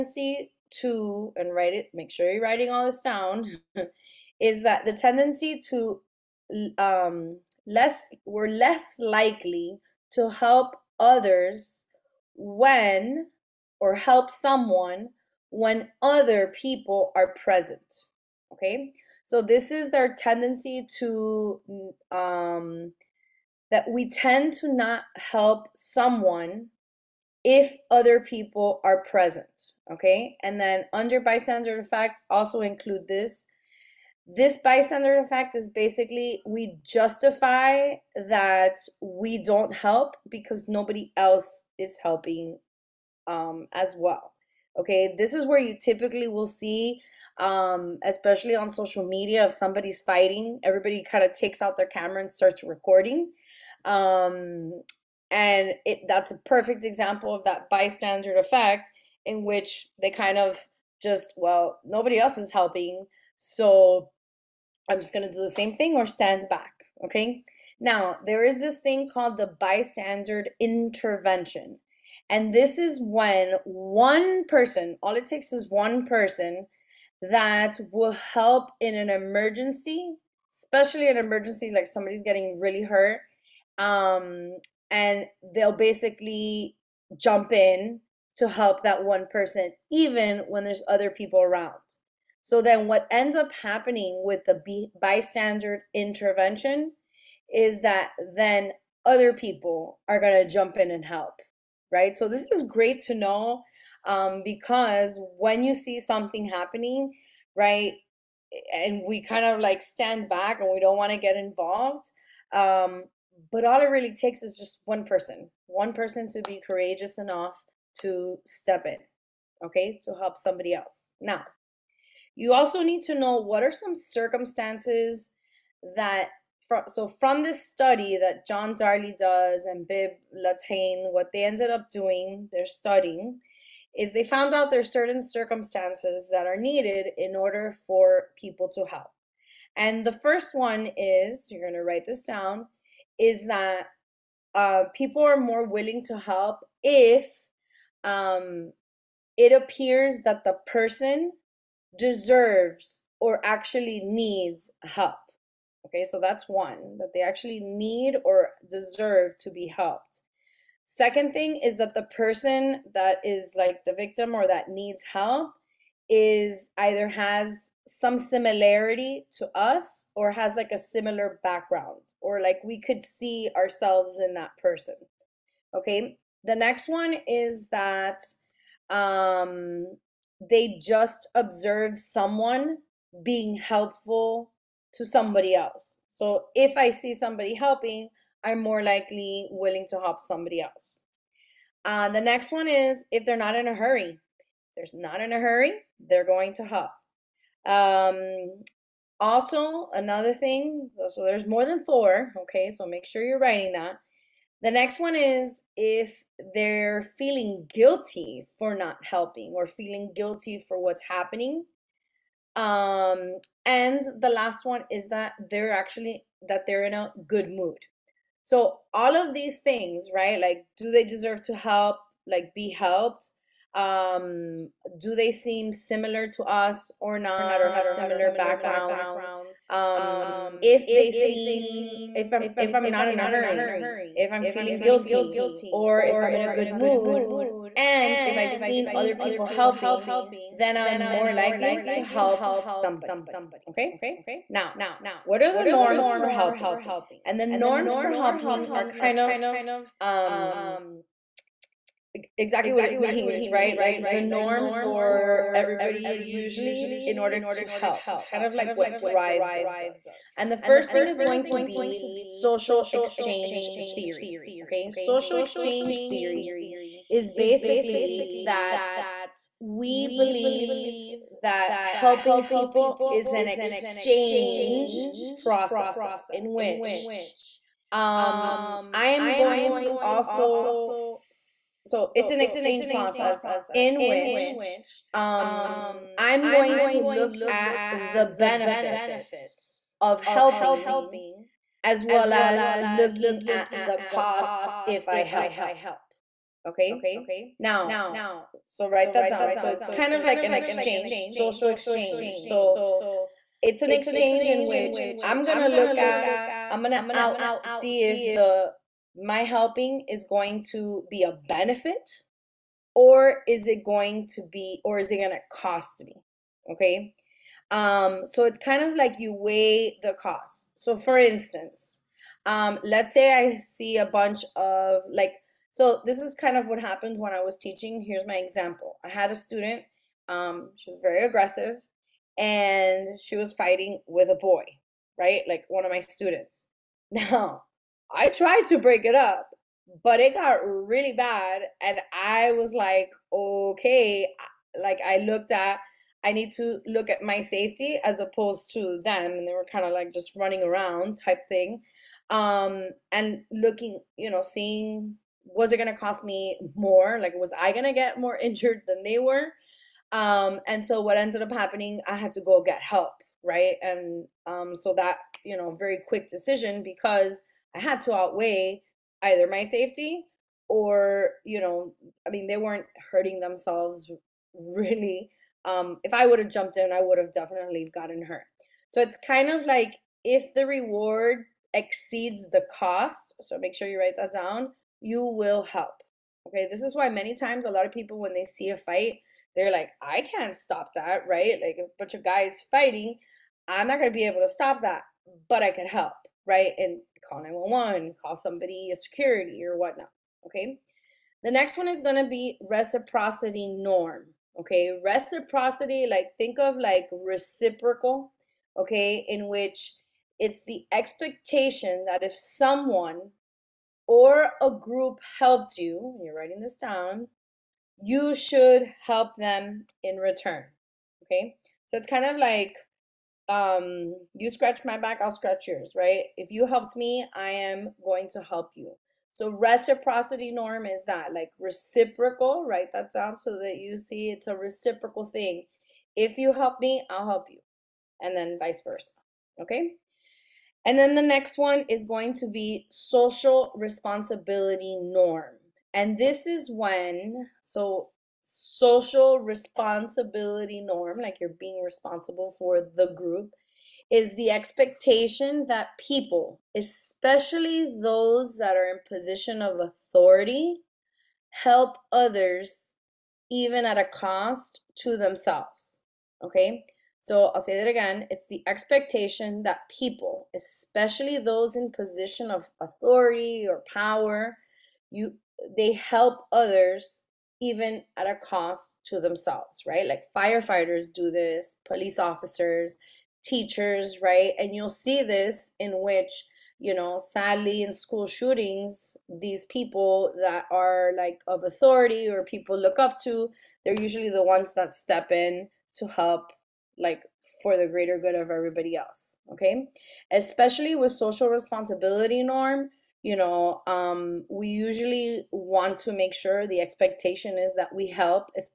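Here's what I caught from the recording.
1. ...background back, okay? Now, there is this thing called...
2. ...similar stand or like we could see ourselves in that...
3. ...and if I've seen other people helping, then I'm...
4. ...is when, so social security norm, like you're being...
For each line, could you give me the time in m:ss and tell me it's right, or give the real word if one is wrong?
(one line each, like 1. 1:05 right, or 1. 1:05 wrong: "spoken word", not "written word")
1. 1:06 wrong: "stand", not "background"
2. 2:50 wrong: "background", not "stand"
3. 3:57 right
4. 7:26 wrong: "responsibility", not "security".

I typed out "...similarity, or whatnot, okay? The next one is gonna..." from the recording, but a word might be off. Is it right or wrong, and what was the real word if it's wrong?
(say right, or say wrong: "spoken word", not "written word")
wrong: "security", not "similarity".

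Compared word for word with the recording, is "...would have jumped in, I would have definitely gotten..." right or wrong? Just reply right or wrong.
right.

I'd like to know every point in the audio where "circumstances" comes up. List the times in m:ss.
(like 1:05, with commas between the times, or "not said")
2:03, 2:15.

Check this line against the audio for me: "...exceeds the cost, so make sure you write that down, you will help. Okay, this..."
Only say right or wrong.
right.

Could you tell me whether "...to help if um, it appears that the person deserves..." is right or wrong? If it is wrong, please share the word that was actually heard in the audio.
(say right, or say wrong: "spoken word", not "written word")
right.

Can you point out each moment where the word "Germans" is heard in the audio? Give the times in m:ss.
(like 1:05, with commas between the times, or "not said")
not said.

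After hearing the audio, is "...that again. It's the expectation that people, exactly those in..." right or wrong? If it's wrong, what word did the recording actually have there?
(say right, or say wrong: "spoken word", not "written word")
wrong: "especially", not "exactly".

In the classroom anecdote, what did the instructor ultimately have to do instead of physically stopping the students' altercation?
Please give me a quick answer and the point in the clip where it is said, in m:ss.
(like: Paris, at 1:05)
go get help, at 6:02.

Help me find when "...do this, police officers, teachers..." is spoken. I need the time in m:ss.
8:01.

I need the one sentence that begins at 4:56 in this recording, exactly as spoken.
Okay, now, so write that down.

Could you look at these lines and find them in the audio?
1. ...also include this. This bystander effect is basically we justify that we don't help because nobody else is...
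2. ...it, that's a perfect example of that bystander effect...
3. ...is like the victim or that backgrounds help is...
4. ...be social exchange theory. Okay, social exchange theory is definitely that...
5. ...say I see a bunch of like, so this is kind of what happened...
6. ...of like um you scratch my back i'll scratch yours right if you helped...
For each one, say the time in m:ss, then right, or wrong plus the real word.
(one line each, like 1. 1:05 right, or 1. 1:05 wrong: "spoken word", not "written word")
1. 0:32 right
2. 0:55 right
3. 2:43 wrong: "needs", not "backgrounds"
4. 4:21 wrong: "basically", not "definitely"
5. 5:23 right
6. 7:02 right.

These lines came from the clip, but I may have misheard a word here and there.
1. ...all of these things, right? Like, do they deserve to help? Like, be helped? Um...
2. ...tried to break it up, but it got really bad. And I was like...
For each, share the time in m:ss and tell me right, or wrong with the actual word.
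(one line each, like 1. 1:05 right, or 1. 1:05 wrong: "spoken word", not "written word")
1. 3:38 right
2. 5:38 right.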